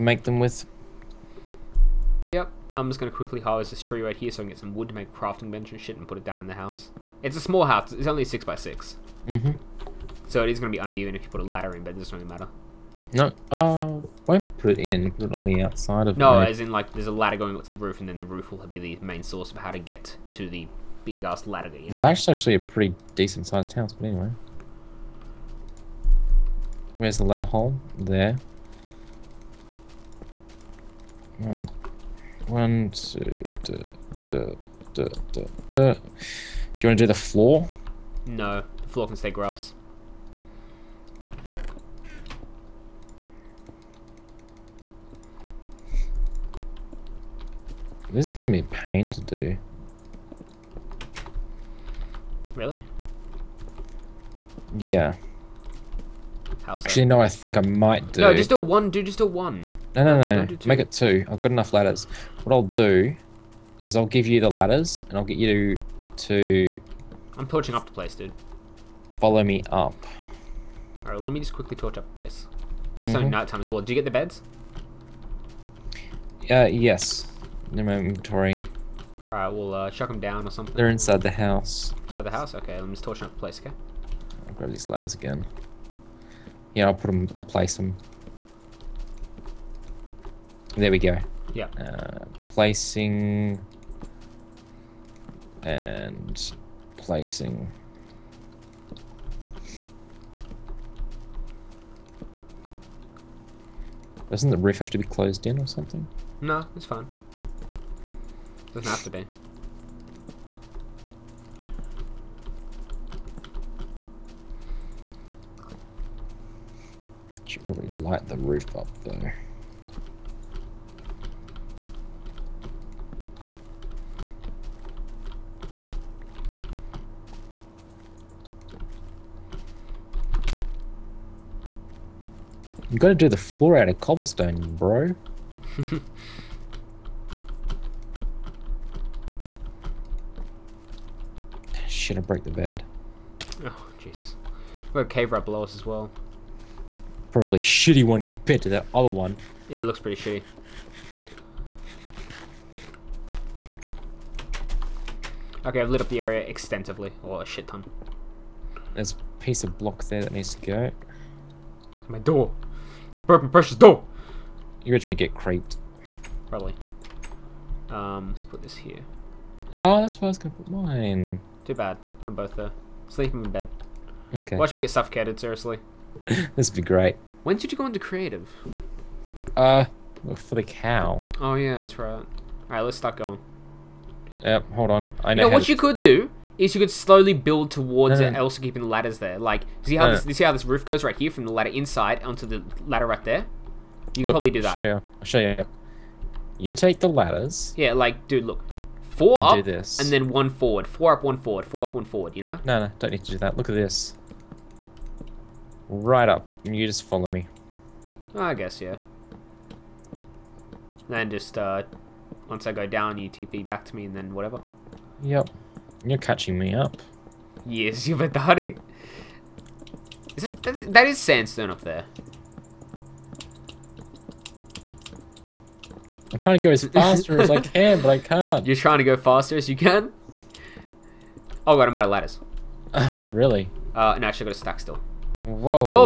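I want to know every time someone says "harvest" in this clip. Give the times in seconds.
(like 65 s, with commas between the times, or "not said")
3 s.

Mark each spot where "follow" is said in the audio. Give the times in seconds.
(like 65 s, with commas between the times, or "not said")
69 s, 207 s.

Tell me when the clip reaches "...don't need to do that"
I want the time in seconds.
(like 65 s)
202 s.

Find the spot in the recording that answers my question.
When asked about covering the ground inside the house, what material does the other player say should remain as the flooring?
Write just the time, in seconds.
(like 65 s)
39 s.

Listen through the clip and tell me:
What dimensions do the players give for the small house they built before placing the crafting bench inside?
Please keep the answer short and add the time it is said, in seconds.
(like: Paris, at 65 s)
6 by 6, at 8 s.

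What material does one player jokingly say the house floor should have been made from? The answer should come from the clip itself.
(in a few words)
cobblestone.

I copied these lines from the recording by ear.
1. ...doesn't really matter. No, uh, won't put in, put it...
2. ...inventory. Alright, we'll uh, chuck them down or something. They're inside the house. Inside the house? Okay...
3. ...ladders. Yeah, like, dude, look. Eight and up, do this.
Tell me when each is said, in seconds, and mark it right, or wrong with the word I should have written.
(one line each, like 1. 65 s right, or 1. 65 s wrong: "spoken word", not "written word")
1. 11 s right
2. 77 s right
3. 197 s wrong: "Four", not "Eight".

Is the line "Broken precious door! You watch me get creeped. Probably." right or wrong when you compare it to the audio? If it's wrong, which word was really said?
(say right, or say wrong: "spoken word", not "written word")
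right.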